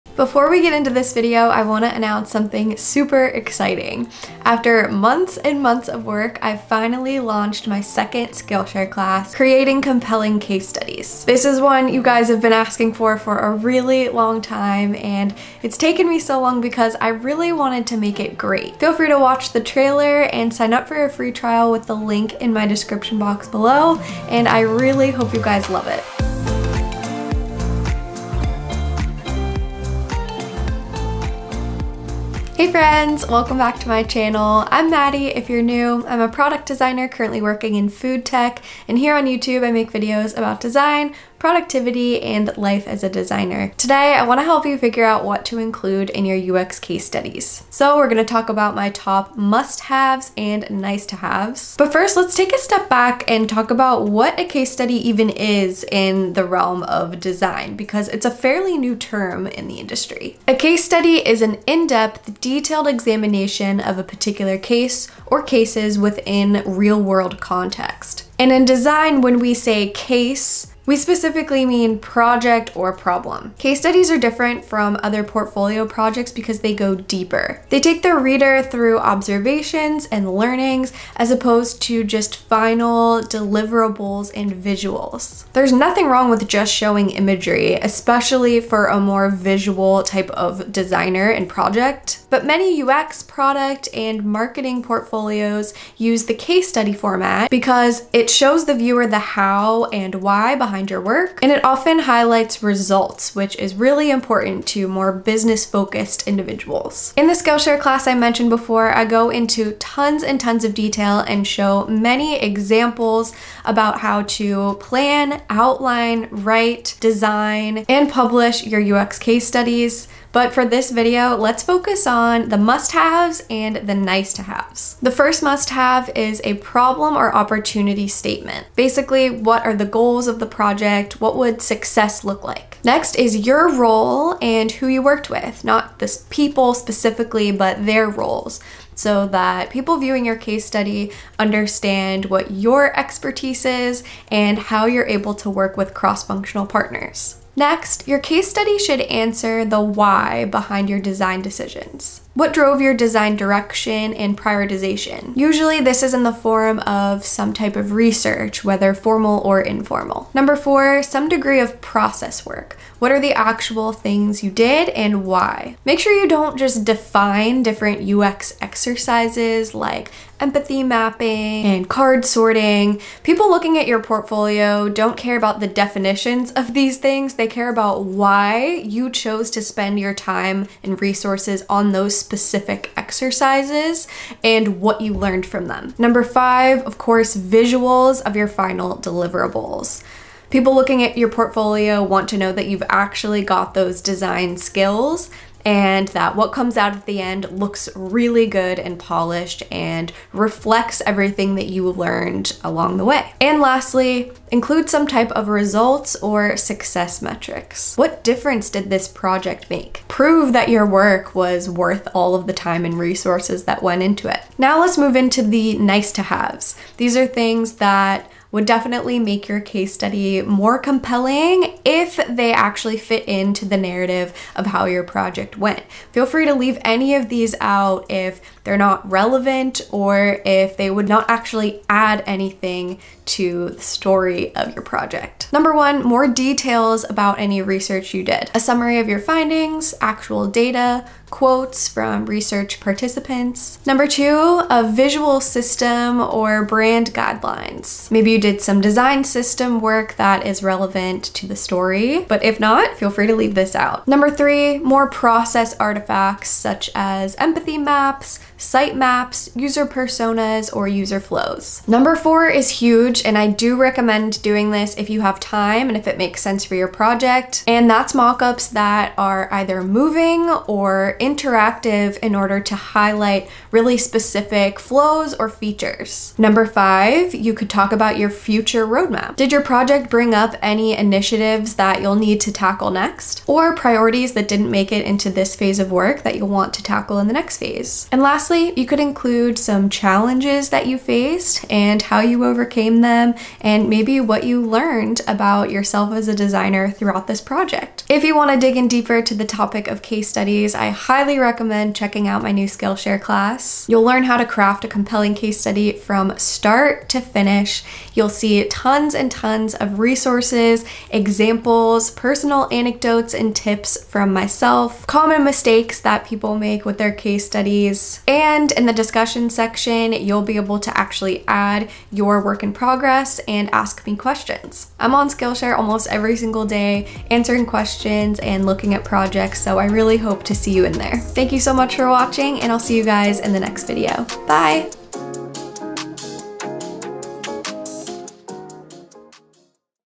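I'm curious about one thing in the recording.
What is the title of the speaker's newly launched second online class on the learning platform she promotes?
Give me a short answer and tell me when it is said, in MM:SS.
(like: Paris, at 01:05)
Creating Compelling Case Studies, at 00:09.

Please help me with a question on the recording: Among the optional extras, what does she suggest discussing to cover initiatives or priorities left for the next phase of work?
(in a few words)
Future roadmap.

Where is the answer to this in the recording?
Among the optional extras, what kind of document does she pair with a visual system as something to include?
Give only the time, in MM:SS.
04:06.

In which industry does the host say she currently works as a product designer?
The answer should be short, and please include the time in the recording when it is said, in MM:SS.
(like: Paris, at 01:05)
Food tech, at 00:37.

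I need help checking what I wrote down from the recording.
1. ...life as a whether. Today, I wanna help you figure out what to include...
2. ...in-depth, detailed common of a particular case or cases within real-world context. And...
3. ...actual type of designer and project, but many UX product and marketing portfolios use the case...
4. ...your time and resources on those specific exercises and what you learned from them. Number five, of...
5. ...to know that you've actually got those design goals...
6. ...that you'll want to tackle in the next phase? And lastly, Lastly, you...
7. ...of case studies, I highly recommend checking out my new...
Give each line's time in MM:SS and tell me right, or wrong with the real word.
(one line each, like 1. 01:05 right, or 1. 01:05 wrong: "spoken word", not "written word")
1. 00:42 wrong: "designer", not "whether"
2. 01:01 wrong: "examination", not "common"
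3. 01:29 wrong: "visual", not "actual"
4. 02:59 right
5. 03:12 wrong: "skills", not "goals"
6. 04:46 right
7. 04:59 right.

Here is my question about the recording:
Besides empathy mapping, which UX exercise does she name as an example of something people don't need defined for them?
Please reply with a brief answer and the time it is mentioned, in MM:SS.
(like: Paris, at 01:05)
Card sorting, at 02:51.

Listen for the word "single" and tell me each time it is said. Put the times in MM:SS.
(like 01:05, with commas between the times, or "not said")
05:26.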